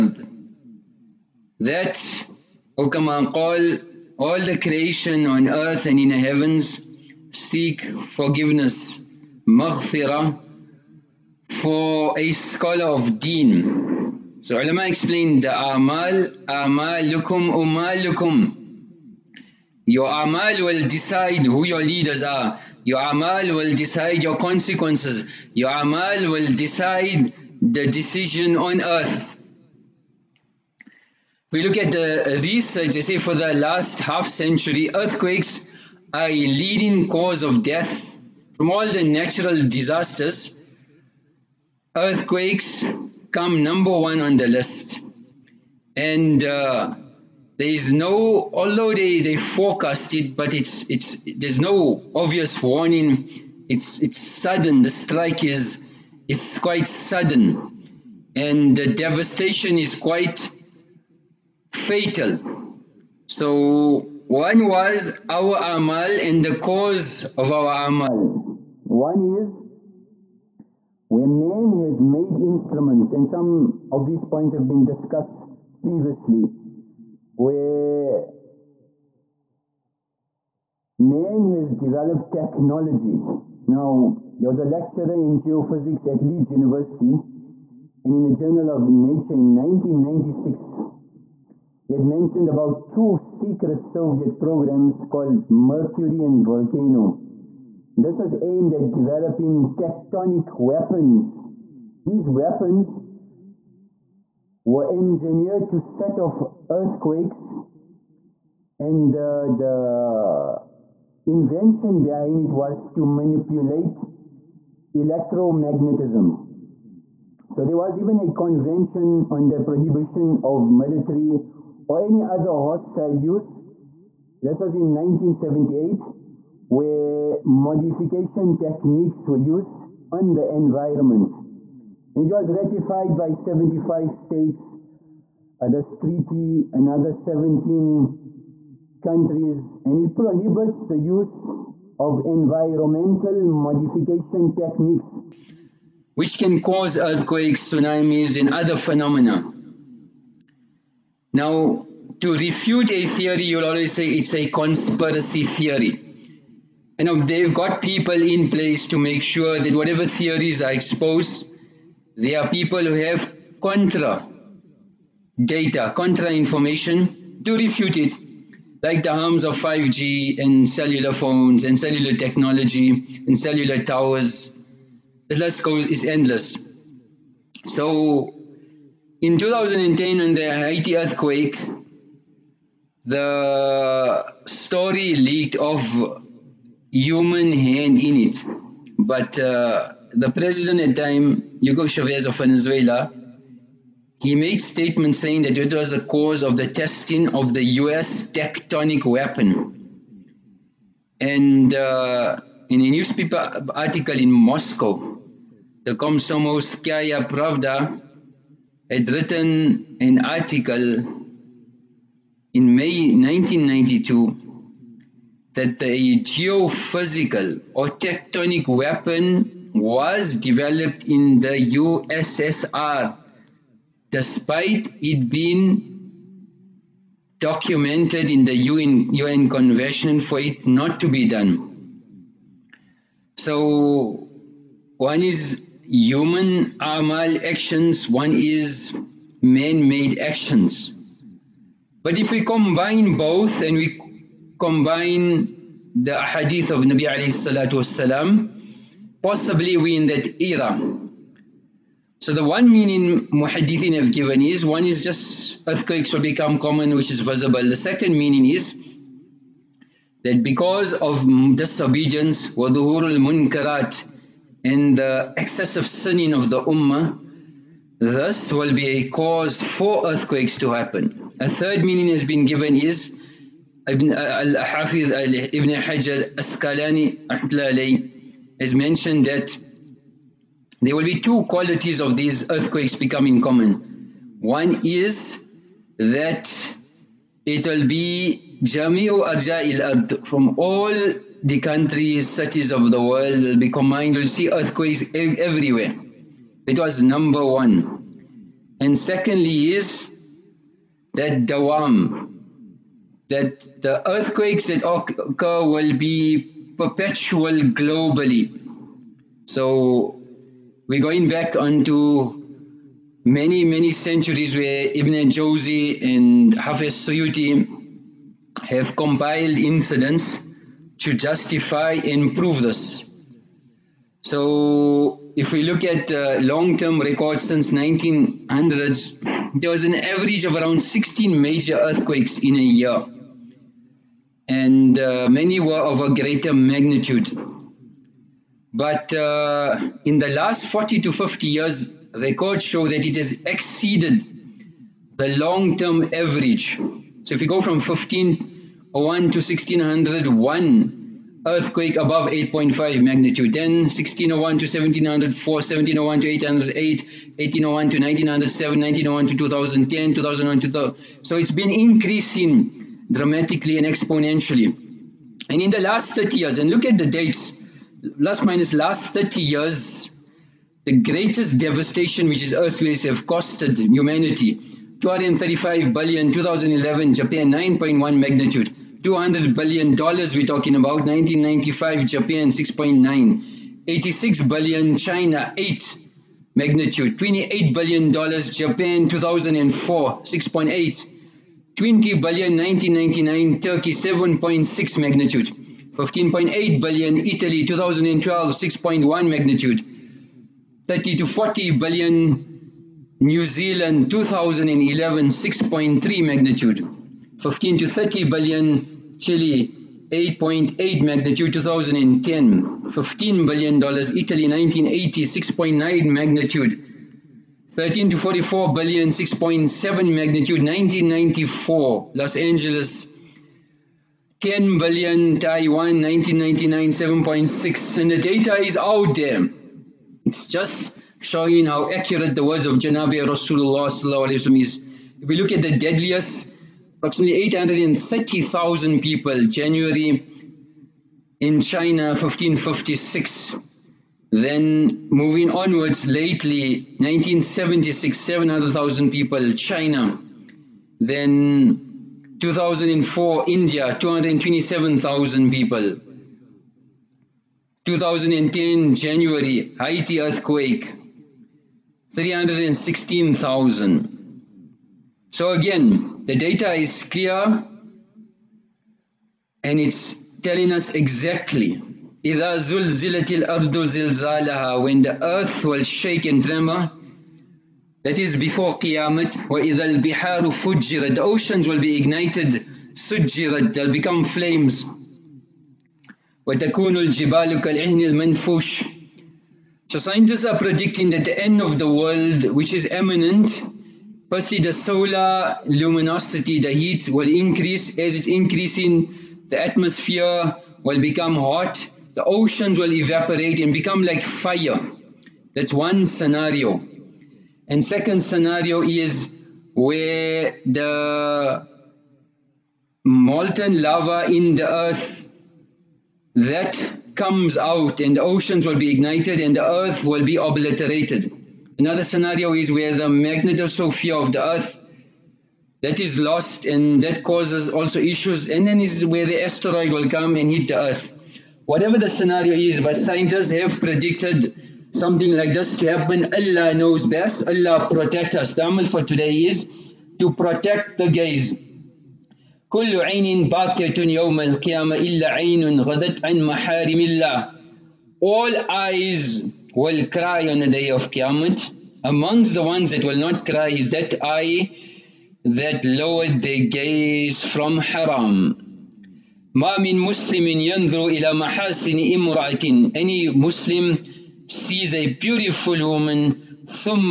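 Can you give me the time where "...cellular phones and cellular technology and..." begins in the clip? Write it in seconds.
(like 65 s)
170 s.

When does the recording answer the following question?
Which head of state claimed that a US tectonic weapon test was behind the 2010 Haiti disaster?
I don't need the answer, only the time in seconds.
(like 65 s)
191 s.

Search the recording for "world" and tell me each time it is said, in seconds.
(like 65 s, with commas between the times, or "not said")
293 s, 491 s.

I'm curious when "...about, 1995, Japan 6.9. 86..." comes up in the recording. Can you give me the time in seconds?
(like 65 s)
380 s.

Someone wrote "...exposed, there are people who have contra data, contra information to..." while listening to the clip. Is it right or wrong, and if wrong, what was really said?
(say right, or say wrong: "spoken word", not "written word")
right.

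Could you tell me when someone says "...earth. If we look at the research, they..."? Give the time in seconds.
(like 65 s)
28 s.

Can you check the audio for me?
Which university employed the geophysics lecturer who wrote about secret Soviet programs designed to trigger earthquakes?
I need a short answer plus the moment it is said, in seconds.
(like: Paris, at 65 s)
Leeds University, at 86 s.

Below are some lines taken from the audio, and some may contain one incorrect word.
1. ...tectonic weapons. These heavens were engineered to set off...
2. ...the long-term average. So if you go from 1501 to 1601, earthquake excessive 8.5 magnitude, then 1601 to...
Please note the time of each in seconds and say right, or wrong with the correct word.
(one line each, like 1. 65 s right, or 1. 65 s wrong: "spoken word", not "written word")
1. 99 s wrong: "weapons", not "heavens"
2. 345 s wrong: "above", not "excessive".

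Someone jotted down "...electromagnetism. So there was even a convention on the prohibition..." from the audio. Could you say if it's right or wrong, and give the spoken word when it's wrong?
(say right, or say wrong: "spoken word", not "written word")
right.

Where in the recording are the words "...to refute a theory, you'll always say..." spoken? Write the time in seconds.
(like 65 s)
152 s.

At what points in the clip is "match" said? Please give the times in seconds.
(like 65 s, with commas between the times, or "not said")
not said.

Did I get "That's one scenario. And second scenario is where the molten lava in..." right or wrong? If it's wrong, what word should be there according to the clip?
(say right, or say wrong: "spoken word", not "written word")
right.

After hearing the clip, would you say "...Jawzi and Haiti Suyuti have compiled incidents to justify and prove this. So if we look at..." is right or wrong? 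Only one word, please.
wrong.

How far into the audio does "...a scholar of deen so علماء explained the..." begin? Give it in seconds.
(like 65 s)
12 s.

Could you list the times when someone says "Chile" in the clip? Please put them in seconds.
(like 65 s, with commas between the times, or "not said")
409 s.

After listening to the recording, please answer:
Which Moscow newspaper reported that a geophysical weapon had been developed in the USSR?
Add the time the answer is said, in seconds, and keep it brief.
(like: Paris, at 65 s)
Komsomolskaya Pravda, at 205 s.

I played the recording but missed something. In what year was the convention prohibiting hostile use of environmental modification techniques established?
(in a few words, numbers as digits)
1978.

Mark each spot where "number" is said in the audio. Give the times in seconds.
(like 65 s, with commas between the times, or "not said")
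43 s, 297 s.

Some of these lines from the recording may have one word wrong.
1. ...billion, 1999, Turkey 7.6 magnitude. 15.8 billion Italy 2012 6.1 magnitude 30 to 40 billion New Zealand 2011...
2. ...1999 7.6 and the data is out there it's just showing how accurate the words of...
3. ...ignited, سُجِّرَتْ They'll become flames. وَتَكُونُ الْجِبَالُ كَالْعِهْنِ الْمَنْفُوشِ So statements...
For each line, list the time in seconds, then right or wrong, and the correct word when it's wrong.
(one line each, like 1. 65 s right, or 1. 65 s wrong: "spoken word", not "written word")
1. 392 s right
2. 426 s right
3. 481 s wrong: "scientists", not "statements".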